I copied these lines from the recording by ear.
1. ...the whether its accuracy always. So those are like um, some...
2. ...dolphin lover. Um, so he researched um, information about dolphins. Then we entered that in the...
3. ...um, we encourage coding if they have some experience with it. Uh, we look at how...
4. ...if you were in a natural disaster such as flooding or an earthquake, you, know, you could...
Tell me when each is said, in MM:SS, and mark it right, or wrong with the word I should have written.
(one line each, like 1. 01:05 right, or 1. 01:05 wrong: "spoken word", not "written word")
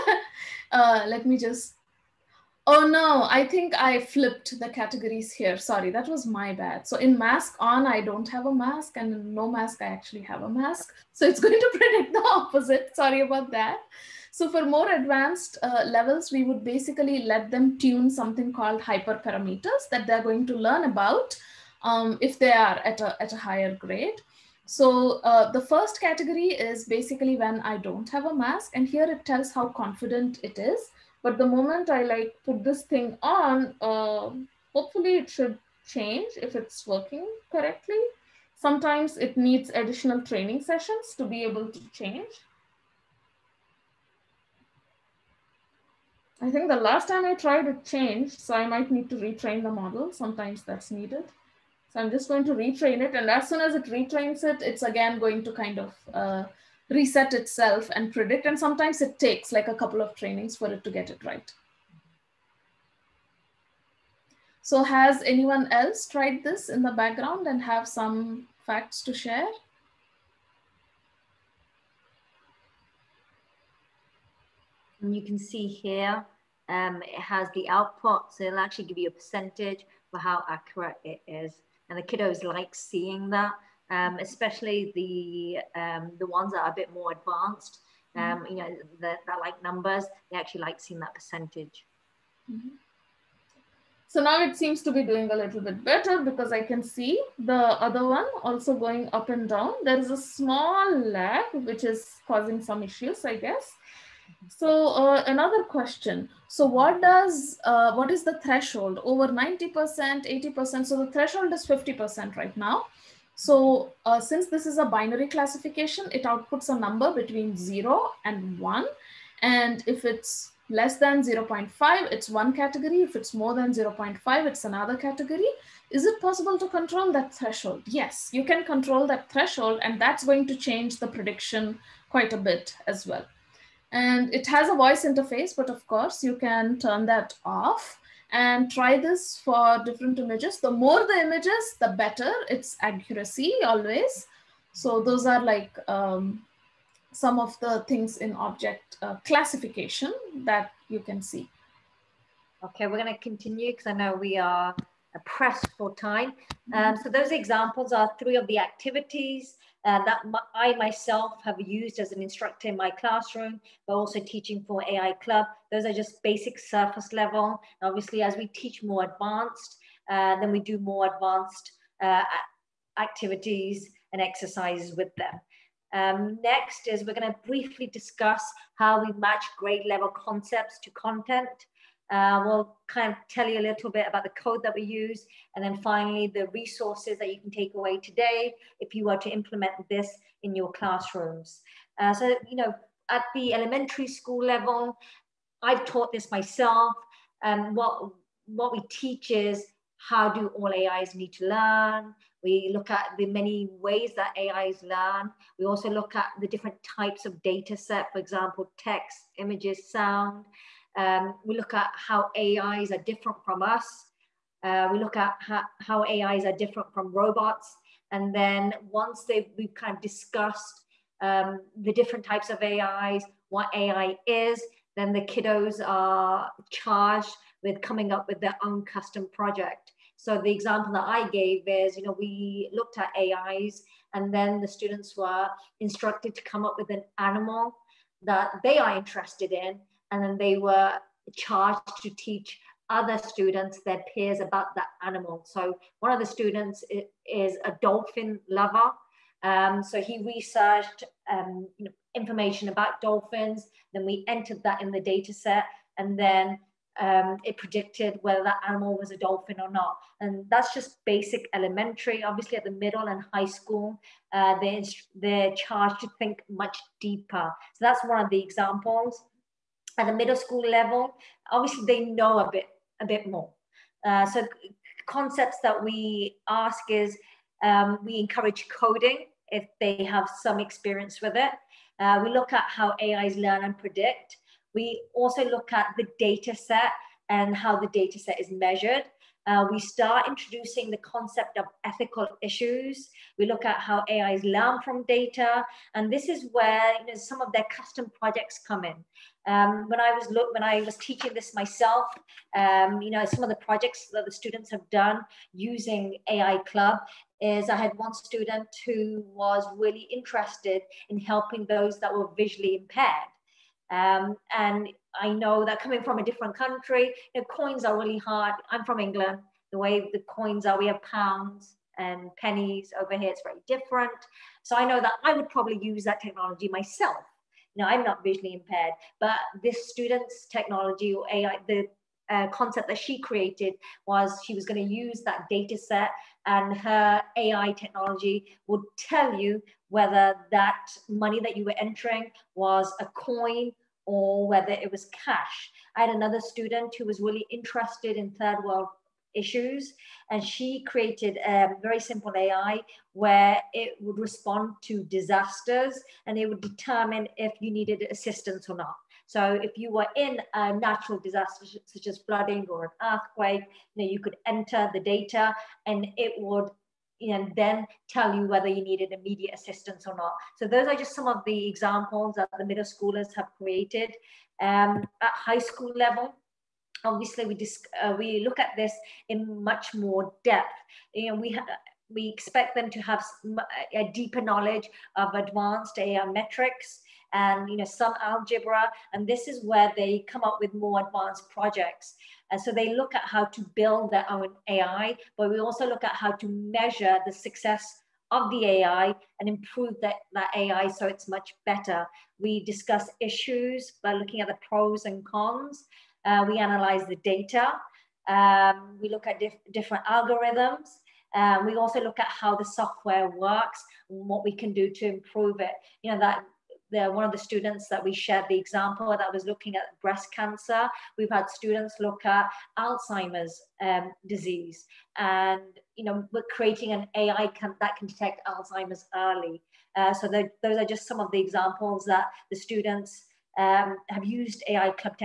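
1. 02:21 wrong: "better", not "whether"
2. 04:07 right
3. 04:37 right
4. 05:59 right.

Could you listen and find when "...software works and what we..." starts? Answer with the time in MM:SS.
06:52.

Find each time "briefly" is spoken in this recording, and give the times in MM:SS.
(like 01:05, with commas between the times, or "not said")
02:57.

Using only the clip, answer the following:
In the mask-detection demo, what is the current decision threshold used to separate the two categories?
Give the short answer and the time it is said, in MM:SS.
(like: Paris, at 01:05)
50%, at 01:51.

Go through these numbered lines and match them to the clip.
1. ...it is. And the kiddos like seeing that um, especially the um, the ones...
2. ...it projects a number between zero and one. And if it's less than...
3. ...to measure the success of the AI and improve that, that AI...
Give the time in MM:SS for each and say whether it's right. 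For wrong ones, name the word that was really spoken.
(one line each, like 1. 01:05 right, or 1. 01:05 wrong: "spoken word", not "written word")
1. 01:21 right
2. 01:56 wrong: "outputs", not "projects"
3. 06:36 right.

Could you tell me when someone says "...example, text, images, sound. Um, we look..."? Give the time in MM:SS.
03:28.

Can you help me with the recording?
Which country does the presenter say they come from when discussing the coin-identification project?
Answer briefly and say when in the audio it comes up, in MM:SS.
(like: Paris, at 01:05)
England, at 05:18.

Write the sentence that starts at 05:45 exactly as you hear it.
I had another student who was really interested in third world issues.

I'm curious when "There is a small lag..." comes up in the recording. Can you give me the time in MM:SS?
01:39.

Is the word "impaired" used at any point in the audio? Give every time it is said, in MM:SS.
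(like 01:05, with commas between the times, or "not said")
05:12, 05:28.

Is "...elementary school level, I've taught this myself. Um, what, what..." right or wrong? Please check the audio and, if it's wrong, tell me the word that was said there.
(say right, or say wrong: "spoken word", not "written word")
right.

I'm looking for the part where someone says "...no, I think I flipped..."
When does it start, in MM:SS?
00:02.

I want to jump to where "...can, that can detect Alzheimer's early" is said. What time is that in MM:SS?
07:07.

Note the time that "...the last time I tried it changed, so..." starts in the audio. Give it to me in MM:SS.
00:46.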